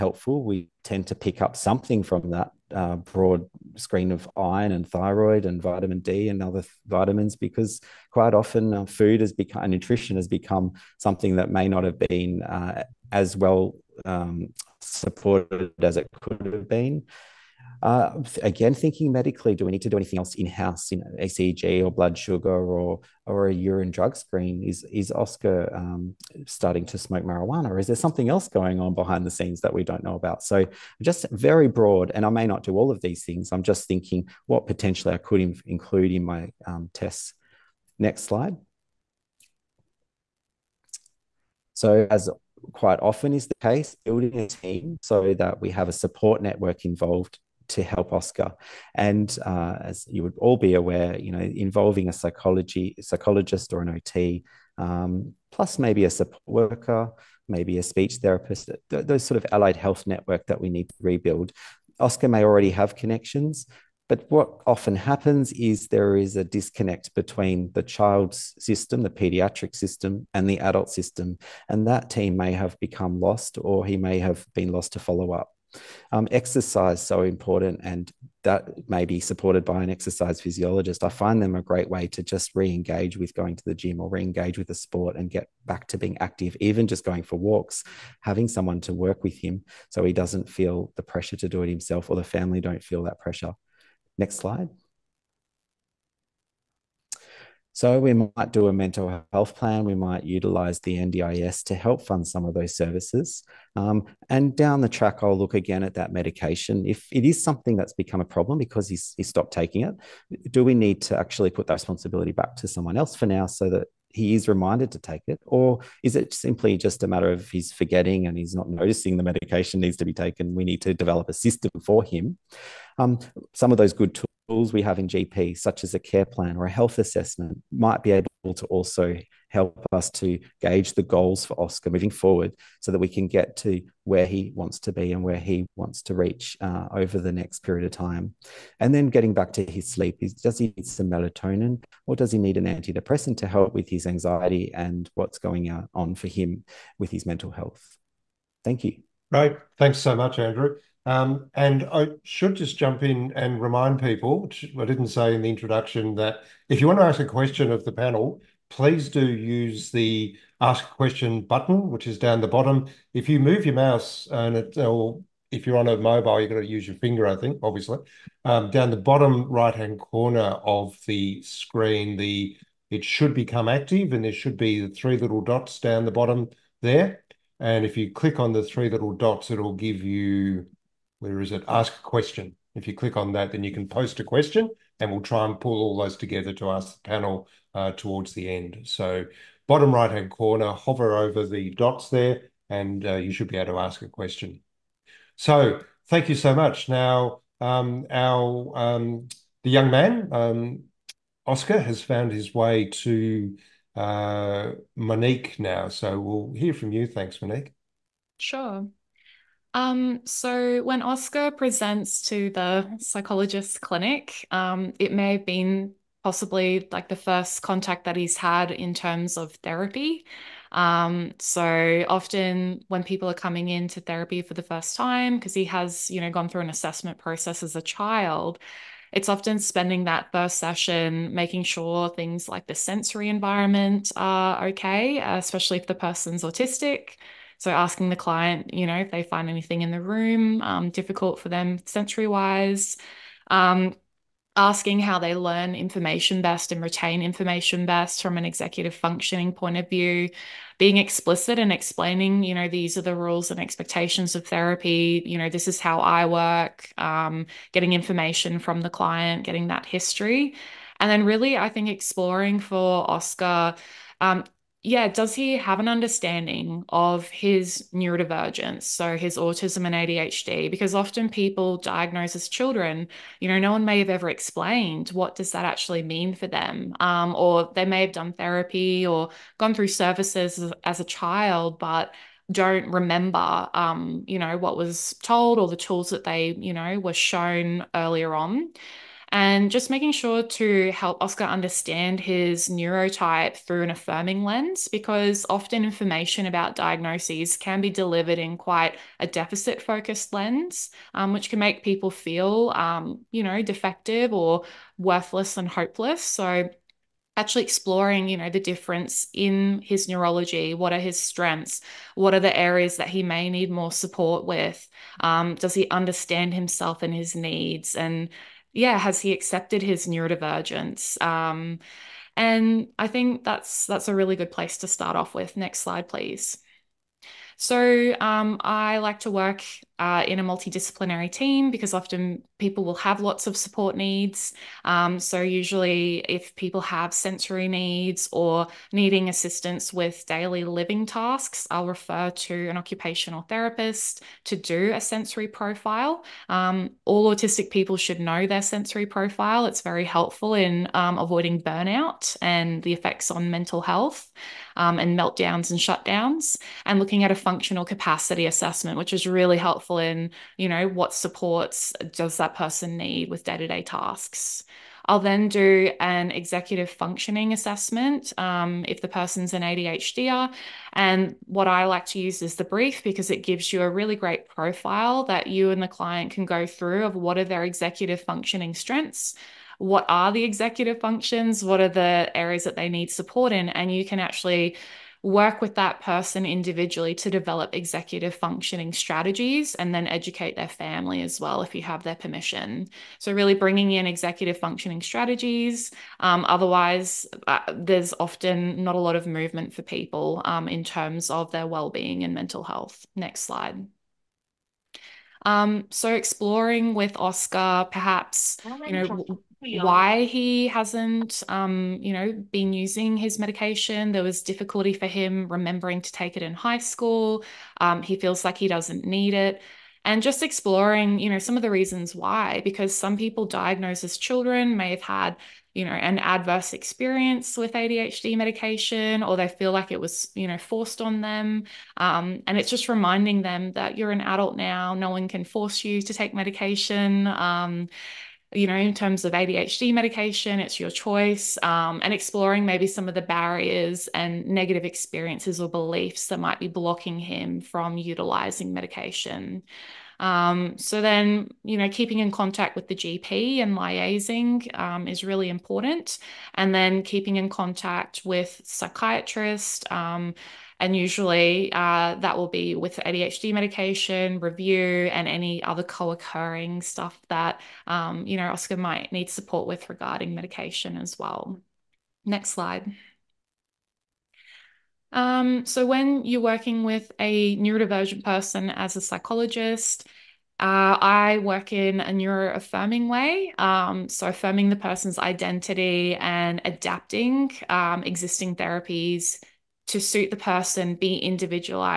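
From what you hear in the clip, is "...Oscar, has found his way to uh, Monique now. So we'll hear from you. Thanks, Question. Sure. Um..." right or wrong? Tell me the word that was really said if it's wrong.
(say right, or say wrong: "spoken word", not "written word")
wrong: "Monique", not "Question".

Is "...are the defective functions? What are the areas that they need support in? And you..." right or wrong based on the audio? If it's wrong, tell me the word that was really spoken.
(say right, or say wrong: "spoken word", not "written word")
wrong: "executive", not "defective".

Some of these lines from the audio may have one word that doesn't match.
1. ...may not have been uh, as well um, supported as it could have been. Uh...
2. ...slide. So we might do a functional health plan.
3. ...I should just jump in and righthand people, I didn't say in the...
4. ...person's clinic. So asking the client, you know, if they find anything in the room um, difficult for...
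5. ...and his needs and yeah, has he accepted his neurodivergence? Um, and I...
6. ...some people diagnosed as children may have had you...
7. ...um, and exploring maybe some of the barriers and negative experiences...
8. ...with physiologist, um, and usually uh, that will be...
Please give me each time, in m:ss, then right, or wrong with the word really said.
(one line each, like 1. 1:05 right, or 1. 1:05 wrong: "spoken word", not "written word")
1. 0:11 right
2. 1:34 wrong: "mental", not "functional"
3. 2:31 wrong: "remind", not "righthand"
4. 3:55 wrong: "autistic", not "clinic"
5. 5:17 right
6. 7:02 right
7. 7:21 right
8. 7:38 wrong: "psychiatrist", not "physiologist".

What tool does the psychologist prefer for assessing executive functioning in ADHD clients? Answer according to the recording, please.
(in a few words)
the BRIEF.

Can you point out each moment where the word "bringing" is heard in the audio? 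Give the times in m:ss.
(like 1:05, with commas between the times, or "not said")
6:33.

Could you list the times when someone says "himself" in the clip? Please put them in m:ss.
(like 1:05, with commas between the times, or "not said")
1:31, 5:16.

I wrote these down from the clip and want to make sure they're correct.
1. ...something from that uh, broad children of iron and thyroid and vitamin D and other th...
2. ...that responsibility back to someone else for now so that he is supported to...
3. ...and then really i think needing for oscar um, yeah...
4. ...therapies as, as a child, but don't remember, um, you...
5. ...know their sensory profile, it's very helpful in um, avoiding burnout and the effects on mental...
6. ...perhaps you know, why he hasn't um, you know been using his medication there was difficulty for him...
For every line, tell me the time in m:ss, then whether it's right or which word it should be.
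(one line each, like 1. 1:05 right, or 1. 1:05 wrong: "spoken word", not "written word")
1. 0:01 wrong: "screen", not "children"
2. 1:51 wrong: "reminded", not "supported"
3. 4:21 wrong: "exploring", not "needing"
4. 4:39 wrong: "services", not "therapies"
5. 5:48 right
6. 6:47 right.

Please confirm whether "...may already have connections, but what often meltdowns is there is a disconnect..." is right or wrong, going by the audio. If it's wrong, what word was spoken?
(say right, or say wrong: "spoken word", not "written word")
wrong: "happens", not "meltdowns".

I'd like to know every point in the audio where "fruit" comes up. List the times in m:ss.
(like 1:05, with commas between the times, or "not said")
not said.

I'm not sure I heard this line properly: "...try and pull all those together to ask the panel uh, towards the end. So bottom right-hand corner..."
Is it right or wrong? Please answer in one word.
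right.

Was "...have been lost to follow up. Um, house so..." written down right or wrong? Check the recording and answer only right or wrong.
wrong.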